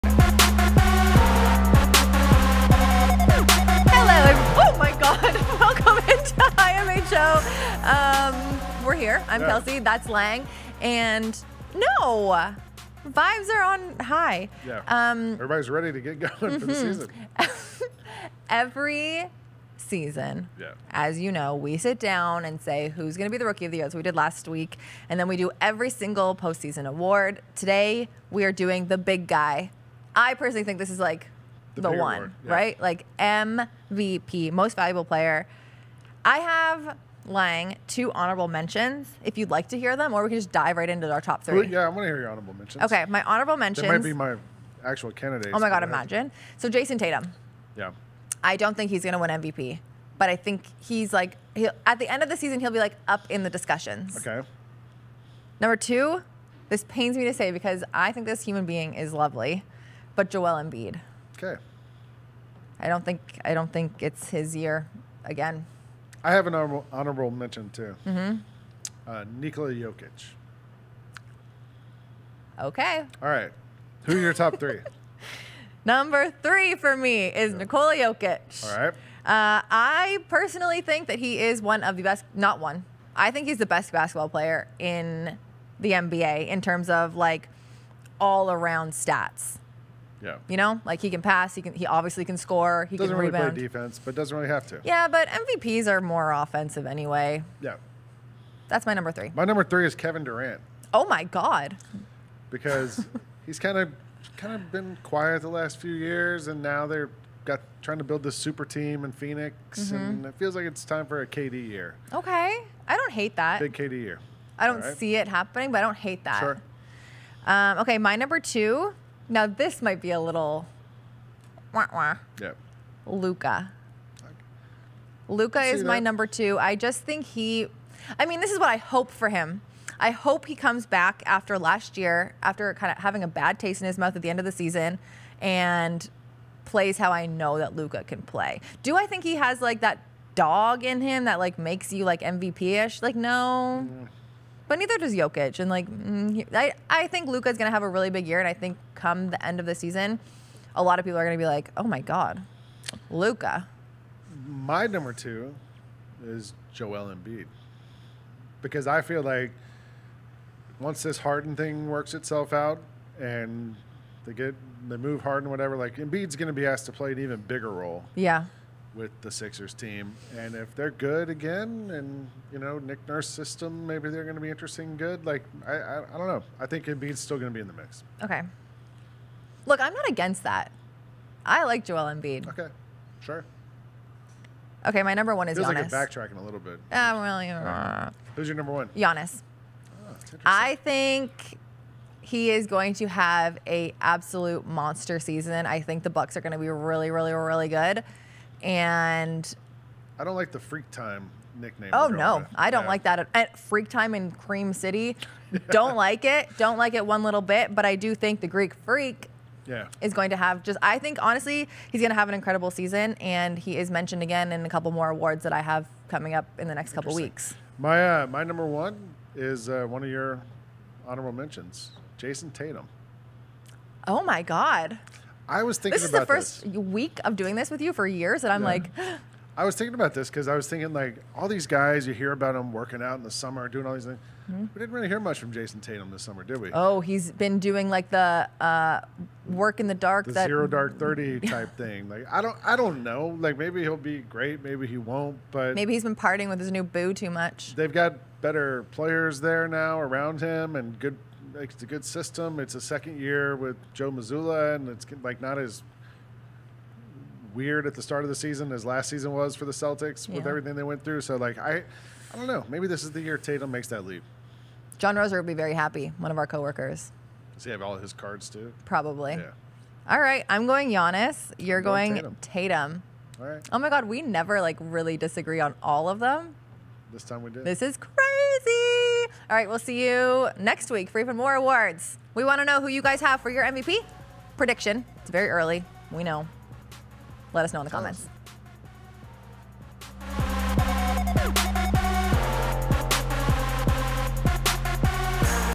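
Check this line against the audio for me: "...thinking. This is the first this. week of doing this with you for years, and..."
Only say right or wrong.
right.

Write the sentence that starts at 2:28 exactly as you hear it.
And I think come the end of the season, a lot of people are going to be like, oh my God, Luka.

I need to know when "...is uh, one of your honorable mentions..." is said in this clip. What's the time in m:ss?
3:39.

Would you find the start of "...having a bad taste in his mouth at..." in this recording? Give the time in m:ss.
2:13.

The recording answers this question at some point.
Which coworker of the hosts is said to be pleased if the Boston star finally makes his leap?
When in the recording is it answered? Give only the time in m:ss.
4:24.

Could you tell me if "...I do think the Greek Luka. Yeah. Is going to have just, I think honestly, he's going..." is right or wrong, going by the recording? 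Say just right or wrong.
wrong.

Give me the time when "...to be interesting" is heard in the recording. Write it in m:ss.
2:54.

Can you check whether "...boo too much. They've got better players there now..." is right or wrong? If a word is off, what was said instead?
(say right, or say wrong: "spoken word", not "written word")
right.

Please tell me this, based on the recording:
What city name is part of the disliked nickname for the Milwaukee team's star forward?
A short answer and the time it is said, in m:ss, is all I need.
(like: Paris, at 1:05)
Cream City, at 3:24.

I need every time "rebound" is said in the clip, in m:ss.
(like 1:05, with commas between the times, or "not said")
1:33.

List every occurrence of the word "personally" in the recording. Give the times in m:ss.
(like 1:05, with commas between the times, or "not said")
0:30, 1:20.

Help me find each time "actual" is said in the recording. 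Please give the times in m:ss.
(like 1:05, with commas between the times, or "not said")
0:44.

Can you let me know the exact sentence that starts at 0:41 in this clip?
Well, yeah, I want to hear your honorable mentions.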